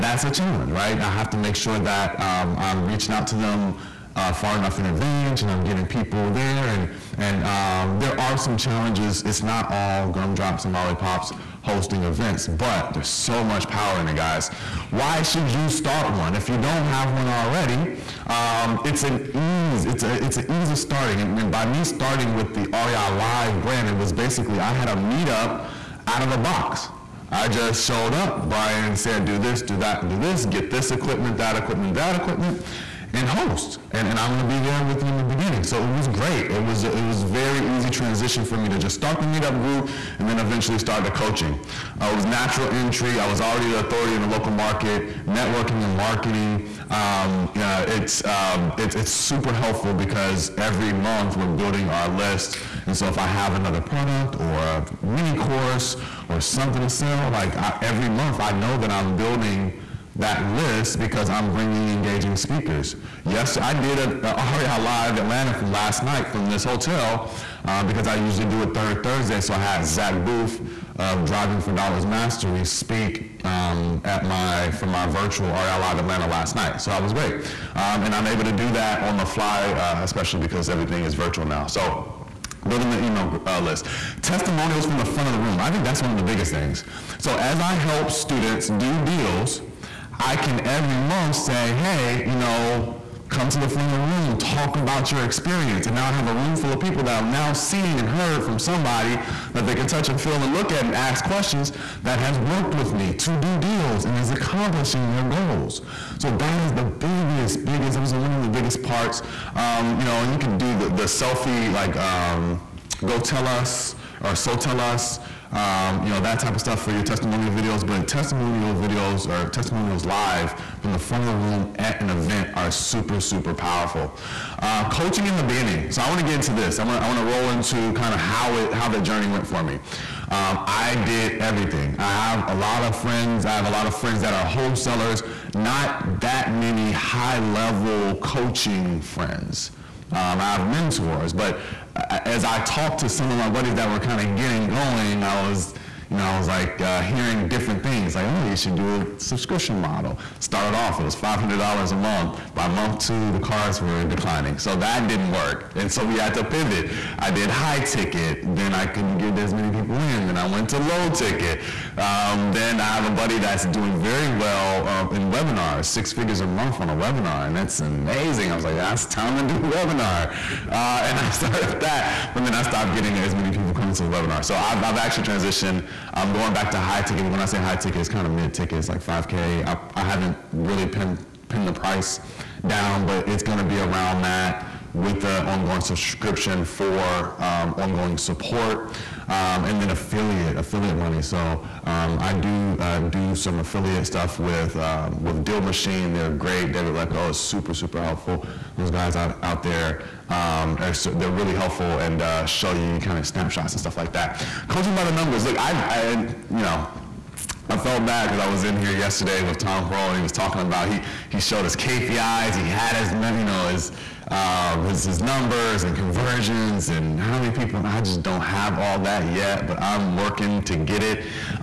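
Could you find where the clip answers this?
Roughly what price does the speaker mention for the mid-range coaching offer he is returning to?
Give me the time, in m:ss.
2:59.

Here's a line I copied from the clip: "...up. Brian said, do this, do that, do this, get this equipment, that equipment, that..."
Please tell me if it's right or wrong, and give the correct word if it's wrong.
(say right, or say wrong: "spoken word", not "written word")
right.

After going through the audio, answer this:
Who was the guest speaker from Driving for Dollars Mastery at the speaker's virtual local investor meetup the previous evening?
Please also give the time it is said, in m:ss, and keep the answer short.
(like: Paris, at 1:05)
Zach Booth, at 1:09.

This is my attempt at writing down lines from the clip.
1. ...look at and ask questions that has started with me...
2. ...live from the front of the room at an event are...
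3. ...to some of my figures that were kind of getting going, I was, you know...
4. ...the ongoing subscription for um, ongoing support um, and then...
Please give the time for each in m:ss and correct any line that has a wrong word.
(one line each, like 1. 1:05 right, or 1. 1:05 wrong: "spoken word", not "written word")
1. 1:40 wrong: "worked", not "started"
2. 2:00 right
3. 2:23 wrong: "buddies", not "figures"
4. 3:05 right.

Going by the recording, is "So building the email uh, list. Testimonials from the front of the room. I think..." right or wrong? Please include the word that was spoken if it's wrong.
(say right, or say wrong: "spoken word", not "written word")
right.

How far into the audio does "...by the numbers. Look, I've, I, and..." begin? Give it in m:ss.
3:24.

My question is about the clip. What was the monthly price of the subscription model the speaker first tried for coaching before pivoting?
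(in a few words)
$500.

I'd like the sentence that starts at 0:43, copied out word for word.
I was already the authority in the local market, networking and marketing.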